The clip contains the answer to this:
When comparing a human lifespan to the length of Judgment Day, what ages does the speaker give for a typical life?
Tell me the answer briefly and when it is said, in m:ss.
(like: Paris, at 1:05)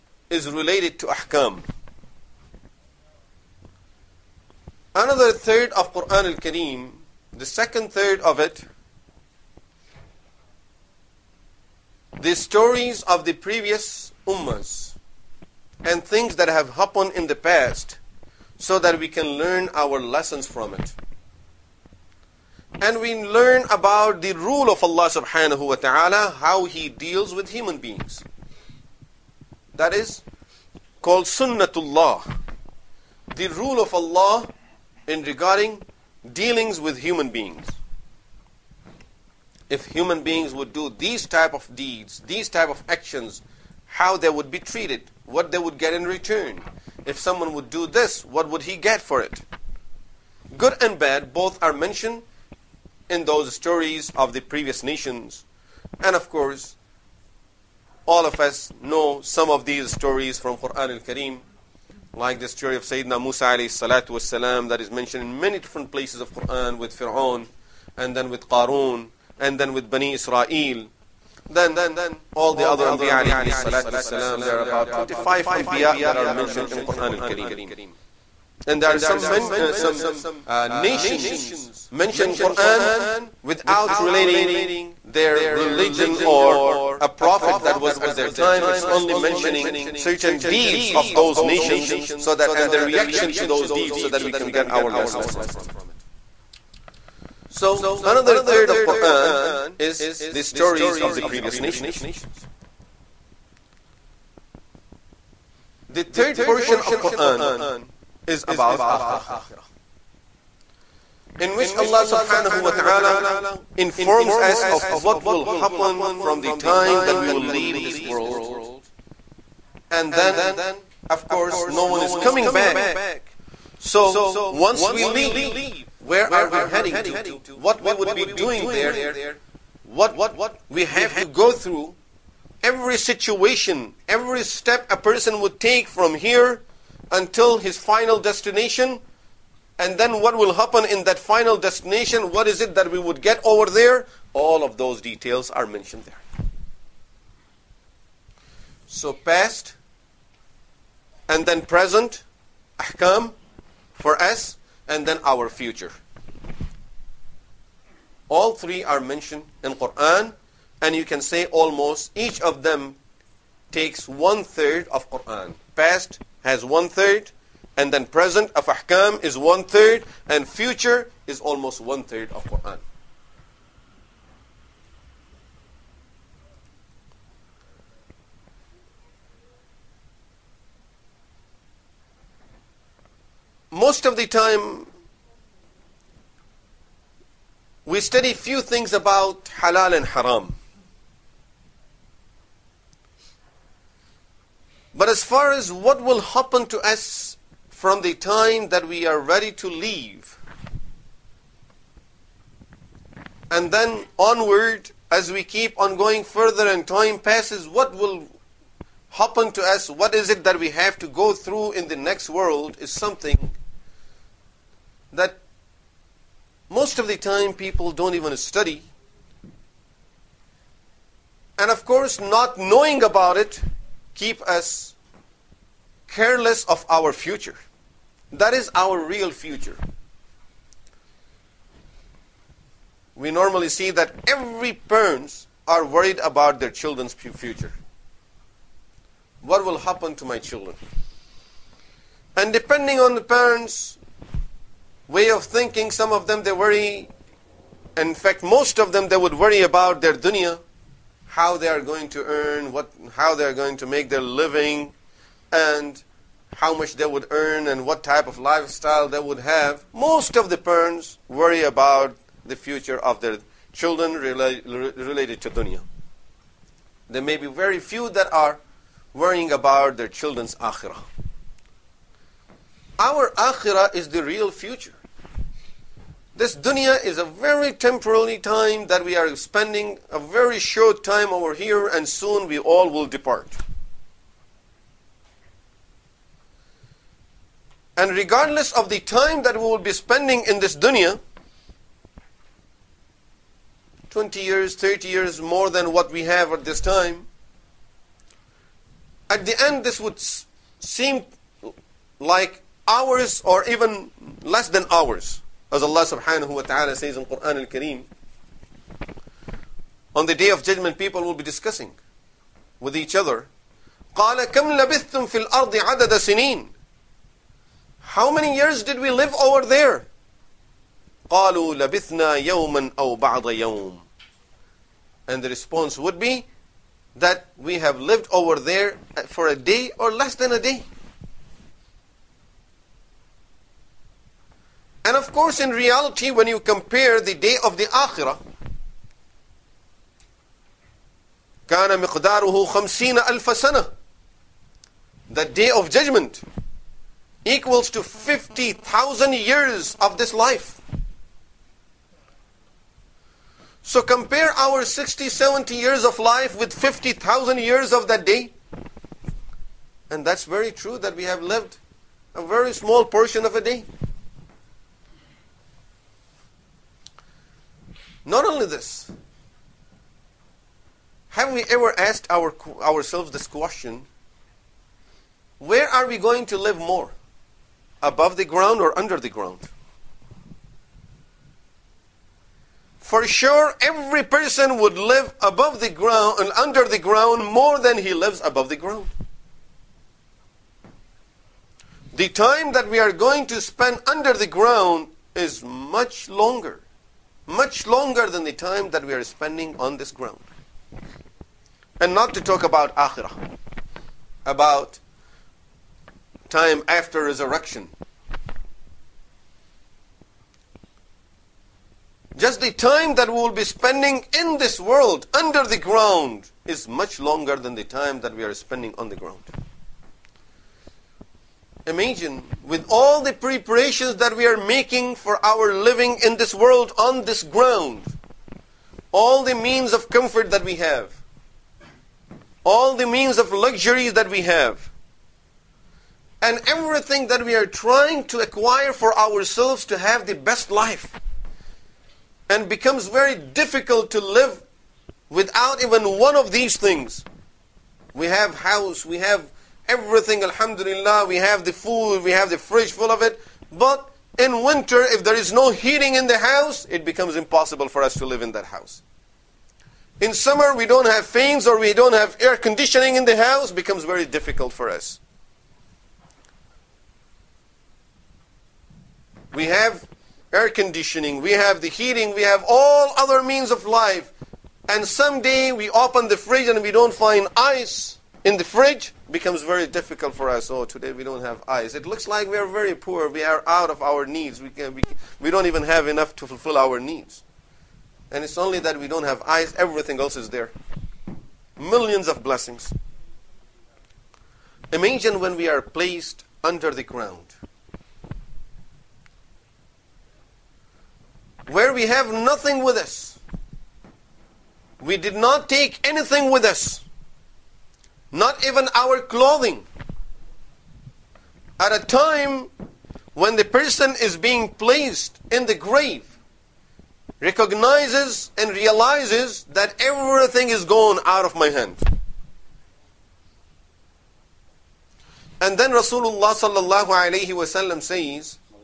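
60, 70 years, at 5:54.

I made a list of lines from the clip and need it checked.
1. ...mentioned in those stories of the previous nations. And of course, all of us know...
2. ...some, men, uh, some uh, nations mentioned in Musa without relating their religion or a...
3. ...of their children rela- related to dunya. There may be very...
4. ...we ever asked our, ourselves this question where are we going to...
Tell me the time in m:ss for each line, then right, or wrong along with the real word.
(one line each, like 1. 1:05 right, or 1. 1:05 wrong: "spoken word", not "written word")
1. 0:51 right
2. 1:18 wrong: "Quran", not "Musa"
3. 4:23 right
4. 6:11 right.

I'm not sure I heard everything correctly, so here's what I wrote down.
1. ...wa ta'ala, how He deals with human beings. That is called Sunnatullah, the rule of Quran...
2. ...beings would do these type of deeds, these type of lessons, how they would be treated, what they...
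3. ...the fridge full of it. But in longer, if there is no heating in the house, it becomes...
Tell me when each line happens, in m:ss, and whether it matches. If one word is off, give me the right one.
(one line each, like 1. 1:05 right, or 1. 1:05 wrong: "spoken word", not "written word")
1. 0:25 wrong: "Allah", not "Quran"
2. 0:40 wrong: "actions", not "lessons"
3. 7:32 wrong: "winter", not "longer".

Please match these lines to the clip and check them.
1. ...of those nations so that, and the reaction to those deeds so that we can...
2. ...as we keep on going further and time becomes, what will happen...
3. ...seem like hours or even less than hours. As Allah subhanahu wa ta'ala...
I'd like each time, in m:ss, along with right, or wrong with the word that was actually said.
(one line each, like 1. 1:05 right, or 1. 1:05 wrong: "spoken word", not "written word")
1. 1:30 right
2. 3:25 wrong: "passes", not "becomes"
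3. 5:00 right.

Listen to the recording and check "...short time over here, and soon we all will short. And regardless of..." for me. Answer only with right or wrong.
wrong.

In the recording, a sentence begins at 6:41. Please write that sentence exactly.
And not to talk about akhirah, about time after resurrection.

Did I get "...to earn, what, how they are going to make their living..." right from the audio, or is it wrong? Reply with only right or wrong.
right.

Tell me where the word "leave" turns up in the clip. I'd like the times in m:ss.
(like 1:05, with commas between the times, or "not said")
1:57, 2:05, 3:19.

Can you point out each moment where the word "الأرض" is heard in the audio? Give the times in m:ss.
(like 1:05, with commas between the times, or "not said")
5:15.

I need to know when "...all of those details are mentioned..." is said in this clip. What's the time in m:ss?
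2:24.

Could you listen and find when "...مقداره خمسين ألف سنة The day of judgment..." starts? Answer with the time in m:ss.
5:42.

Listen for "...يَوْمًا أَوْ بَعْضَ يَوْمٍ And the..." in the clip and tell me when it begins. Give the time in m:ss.
5:22.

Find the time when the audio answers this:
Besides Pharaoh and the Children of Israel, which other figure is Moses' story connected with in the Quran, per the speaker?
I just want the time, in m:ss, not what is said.
1:08.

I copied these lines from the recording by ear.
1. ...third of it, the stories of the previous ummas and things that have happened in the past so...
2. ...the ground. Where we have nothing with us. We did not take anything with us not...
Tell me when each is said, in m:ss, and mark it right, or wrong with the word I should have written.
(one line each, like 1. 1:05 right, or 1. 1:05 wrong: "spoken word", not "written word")
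1. 0:07 right
2. 8:16 right.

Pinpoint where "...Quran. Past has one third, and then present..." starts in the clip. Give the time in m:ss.
2:45.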